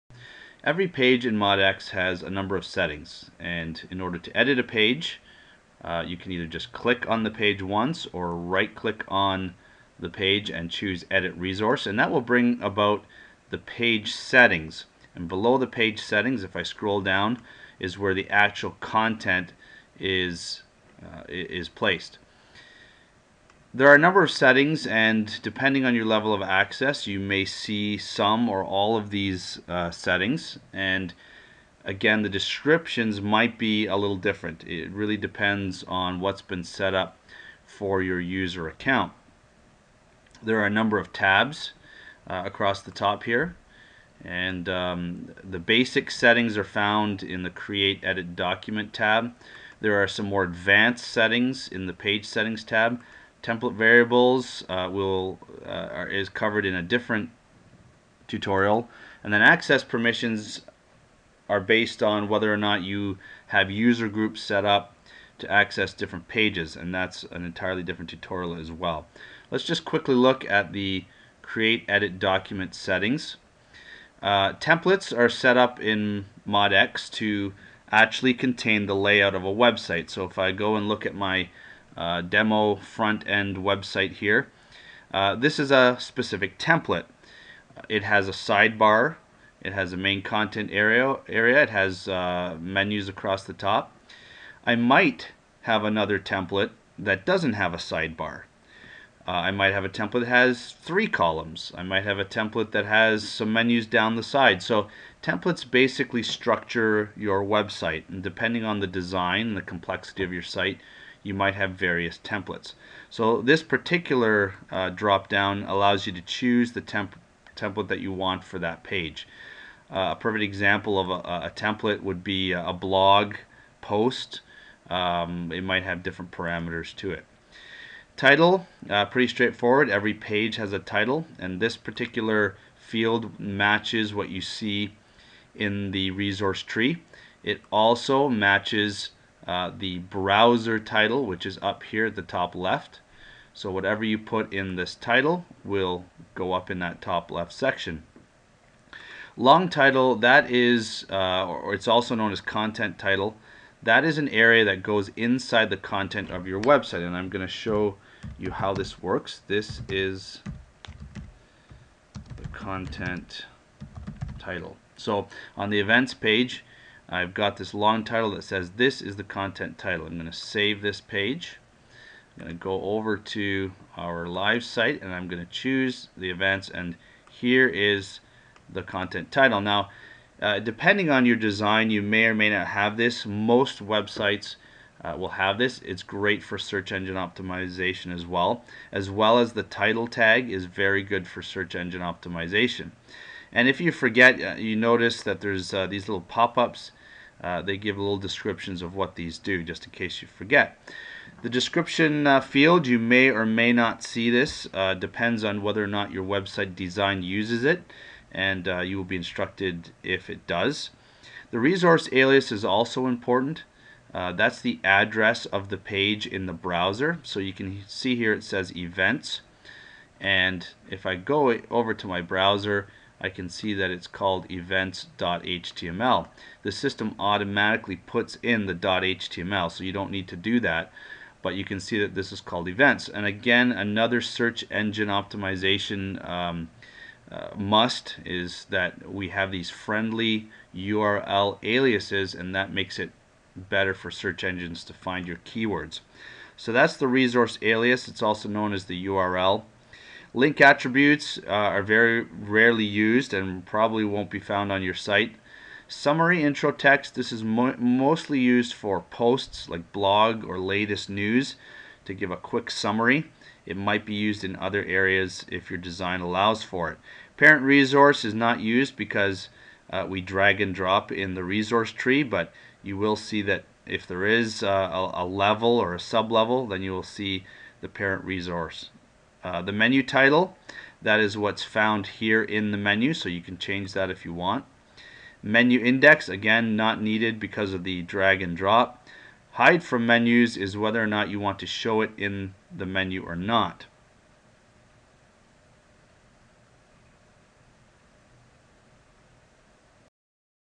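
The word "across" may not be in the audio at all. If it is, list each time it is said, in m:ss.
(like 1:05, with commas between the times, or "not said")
0:42, 1:33.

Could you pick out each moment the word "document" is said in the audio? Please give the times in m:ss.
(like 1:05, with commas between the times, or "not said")
0:48, 1:12.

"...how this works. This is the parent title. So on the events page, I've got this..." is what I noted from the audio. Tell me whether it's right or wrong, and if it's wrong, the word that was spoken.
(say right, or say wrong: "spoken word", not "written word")
wrong: "content", not "parent".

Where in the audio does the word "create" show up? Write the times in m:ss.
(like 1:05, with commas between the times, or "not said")
0:47, 1:11.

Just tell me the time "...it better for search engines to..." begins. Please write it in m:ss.
4:02.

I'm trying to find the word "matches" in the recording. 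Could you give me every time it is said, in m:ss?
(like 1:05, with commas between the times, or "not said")
2:13, 2:18.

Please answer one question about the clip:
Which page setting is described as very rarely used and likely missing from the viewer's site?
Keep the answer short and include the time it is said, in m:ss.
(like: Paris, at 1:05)
Link attributes, at 4:10.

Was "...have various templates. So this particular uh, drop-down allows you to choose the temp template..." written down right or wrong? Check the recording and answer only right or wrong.
right.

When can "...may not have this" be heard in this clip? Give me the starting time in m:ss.
3:02.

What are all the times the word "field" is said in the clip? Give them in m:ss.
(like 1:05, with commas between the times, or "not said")
2:12, 3:22.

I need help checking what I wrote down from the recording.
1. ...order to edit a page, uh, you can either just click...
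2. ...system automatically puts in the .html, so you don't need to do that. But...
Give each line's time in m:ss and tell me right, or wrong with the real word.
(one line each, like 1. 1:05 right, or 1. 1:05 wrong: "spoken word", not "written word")
1. 0:03 right
2. 3:46 right.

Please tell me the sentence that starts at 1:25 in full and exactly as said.
Uh, this is a specific template.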